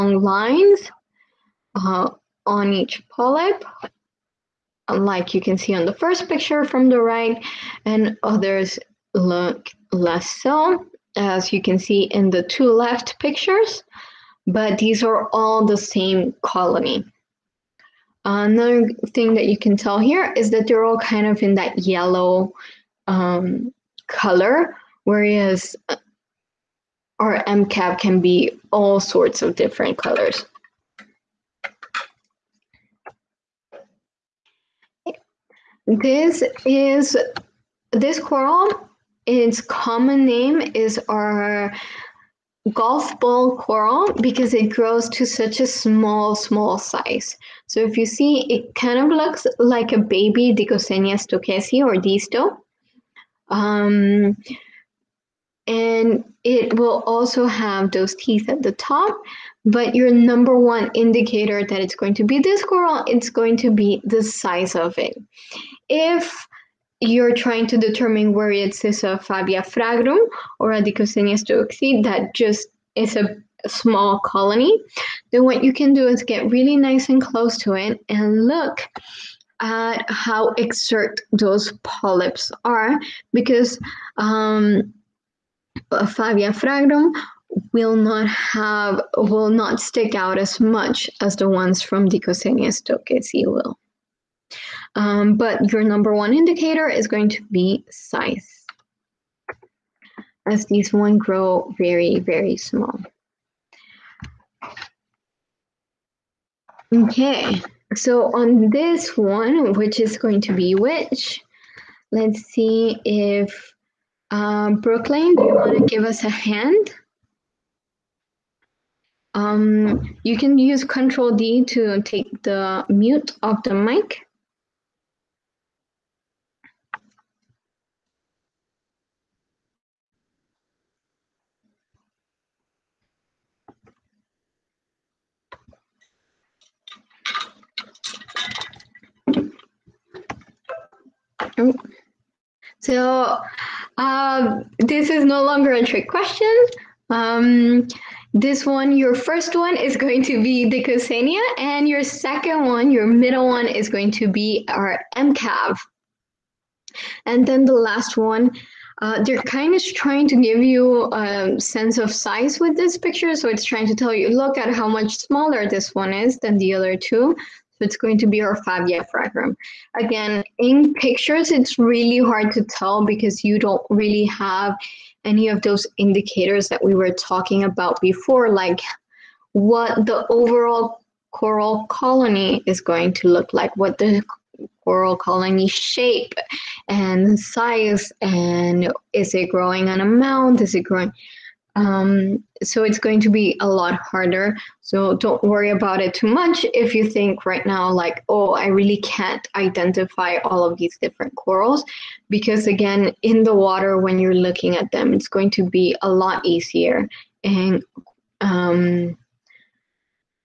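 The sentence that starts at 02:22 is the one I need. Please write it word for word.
So uh, this is no longer a trick question.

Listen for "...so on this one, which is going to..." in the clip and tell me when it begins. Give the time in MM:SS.
01:47.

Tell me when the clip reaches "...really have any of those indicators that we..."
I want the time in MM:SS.
02:53.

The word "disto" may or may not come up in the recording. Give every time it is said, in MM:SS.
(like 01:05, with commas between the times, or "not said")
00:51.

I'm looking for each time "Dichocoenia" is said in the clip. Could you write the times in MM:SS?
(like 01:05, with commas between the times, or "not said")
00:50, 01:10, 01:32.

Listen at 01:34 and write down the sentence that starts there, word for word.
Um, but your number one indicator is going to be size, as these one grow very, very small.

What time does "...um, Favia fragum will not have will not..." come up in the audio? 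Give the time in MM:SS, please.
01:24.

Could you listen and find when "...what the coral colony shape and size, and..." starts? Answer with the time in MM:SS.
03:03.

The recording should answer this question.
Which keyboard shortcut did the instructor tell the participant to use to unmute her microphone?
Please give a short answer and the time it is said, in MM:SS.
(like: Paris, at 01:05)
Control D, at 02:00.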